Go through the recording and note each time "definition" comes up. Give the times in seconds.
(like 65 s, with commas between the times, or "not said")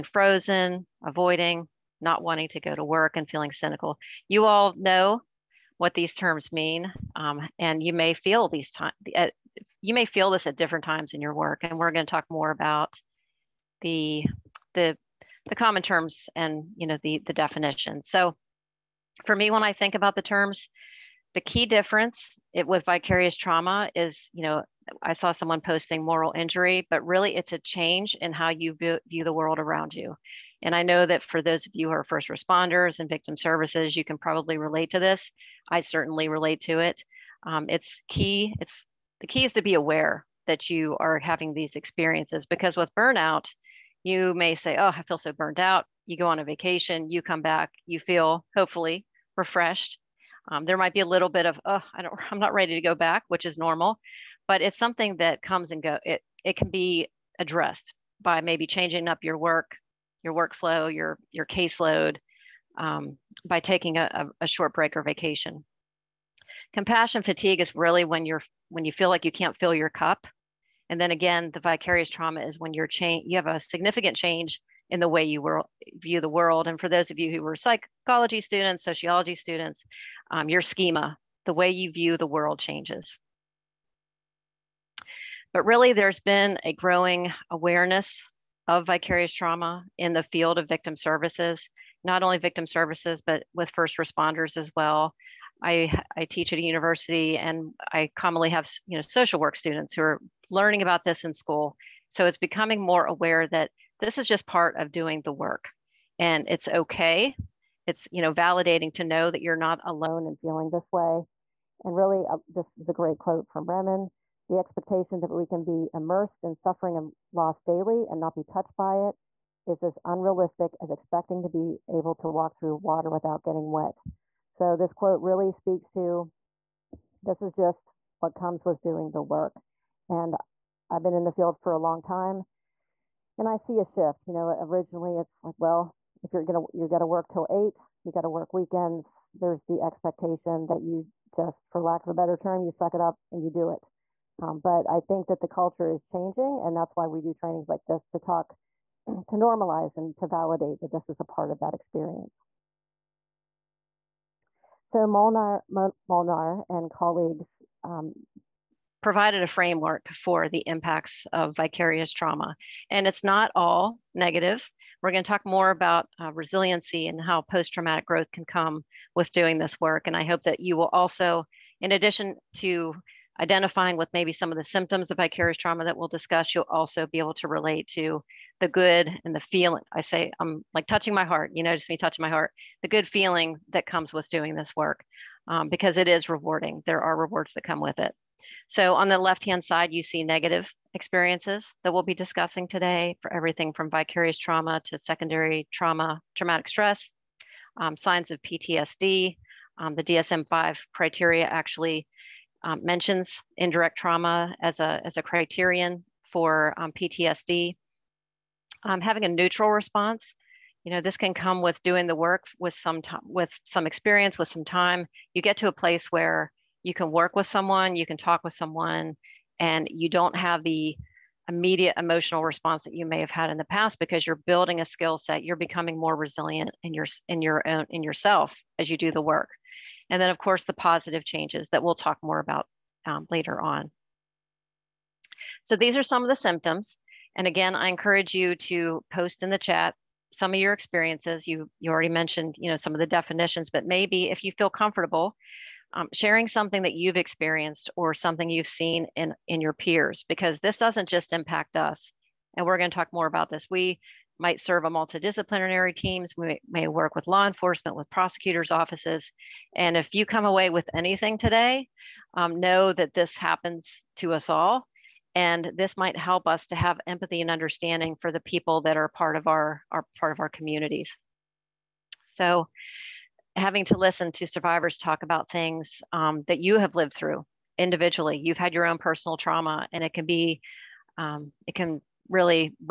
17 s, 243 s.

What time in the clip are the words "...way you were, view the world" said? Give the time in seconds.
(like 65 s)
75 s.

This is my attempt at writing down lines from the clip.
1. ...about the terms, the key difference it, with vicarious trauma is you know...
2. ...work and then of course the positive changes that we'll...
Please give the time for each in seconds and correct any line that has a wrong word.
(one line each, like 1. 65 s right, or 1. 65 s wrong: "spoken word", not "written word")
1. 19 s right
2. 229 s right.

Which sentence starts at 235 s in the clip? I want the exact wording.
So these are some of the symptoms.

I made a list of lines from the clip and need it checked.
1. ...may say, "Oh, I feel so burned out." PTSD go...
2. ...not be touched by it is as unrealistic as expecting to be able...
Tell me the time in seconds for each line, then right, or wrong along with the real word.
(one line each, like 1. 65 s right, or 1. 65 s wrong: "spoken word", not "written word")
1. 44 s wrong: "You", not "PTSD"
2. 118 s right.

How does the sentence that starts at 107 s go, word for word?
It's you know validating to know that you're not alone in feeling this way.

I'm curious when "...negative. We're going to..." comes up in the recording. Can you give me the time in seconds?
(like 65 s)
164 s.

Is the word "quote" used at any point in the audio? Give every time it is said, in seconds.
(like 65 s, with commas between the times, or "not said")
113 s, 124 s.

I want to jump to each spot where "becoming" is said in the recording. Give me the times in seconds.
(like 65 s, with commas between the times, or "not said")
102 s, 225 s.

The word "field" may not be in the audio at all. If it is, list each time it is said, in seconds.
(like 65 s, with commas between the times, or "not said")
90 s, 131 s.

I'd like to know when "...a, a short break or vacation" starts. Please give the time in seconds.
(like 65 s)
63 s.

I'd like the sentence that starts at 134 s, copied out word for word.
You know, originally it's like, well, if you're gonna you're gonna work till eight, you gotta work weekends.